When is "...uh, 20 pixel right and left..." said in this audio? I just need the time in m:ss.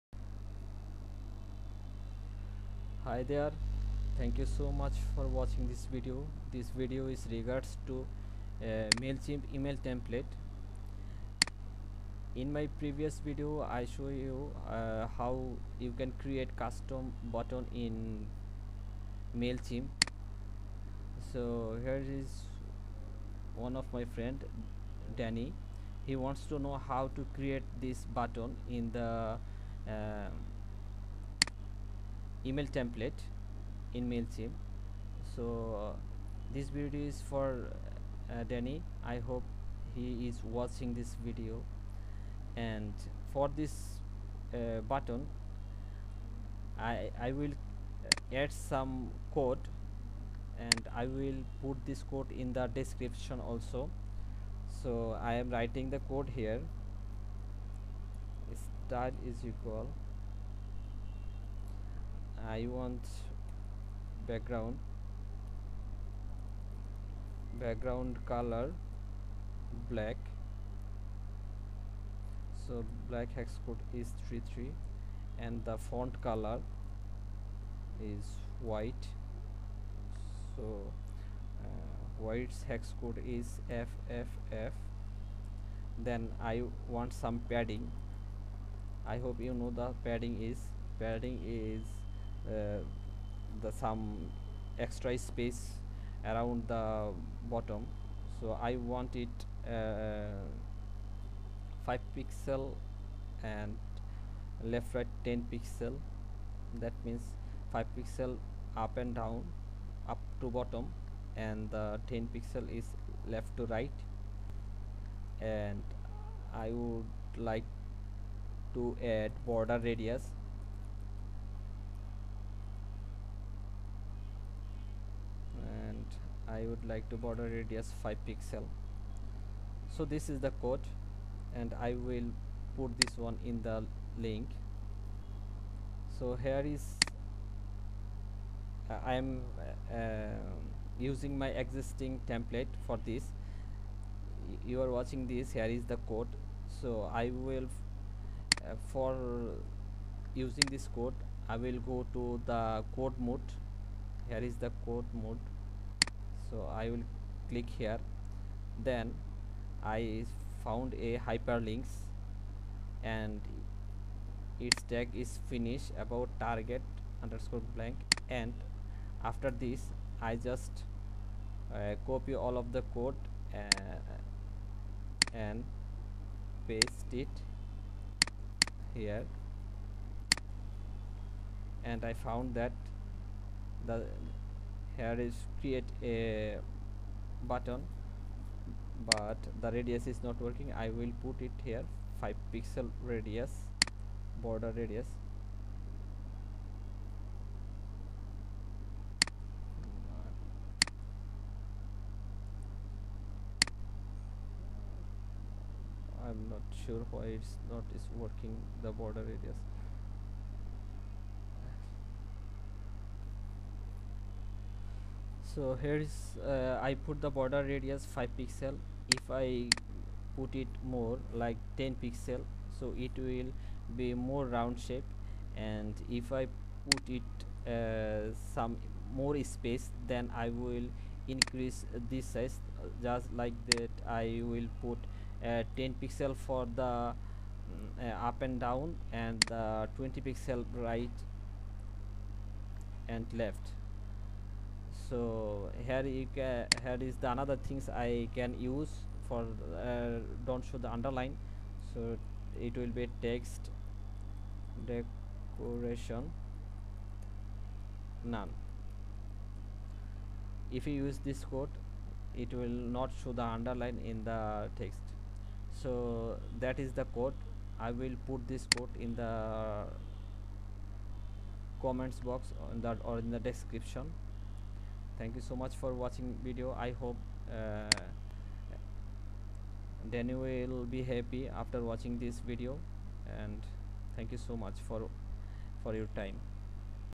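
3:59.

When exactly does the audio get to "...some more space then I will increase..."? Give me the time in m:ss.
3:48.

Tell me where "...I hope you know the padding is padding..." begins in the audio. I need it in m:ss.
1:29.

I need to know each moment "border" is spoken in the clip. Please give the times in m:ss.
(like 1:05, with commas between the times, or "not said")
1:59, 2:07, 3:14, 3:28, 3:37.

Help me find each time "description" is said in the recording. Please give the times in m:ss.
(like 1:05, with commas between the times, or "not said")
0:52, 4:33.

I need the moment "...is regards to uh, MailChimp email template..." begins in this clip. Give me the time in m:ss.
0:07.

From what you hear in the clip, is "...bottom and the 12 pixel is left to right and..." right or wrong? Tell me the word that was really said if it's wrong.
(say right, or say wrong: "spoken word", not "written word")
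wrong: "10", not "12".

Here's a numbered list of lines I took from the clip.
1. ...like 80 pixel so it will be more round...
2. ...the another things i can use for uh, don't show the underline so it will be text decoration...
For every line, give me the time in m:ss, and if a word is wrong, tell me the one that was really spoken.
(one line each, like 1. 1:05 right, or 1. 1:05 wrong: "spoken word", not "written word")
1. 3:41 wrong: "10", not "80"
2. 4:07 right.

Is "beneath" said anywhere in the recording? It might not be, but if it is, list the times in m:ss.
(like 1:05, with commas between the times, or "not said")
not said.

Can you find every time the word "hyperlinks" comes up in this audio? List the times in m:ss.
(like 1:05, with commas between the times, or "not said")
2:41.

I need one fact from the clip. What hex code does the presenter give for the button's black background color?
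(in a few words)
33.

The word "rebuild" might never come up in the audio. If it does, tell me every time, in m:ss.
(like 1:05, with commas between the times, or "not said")
not said.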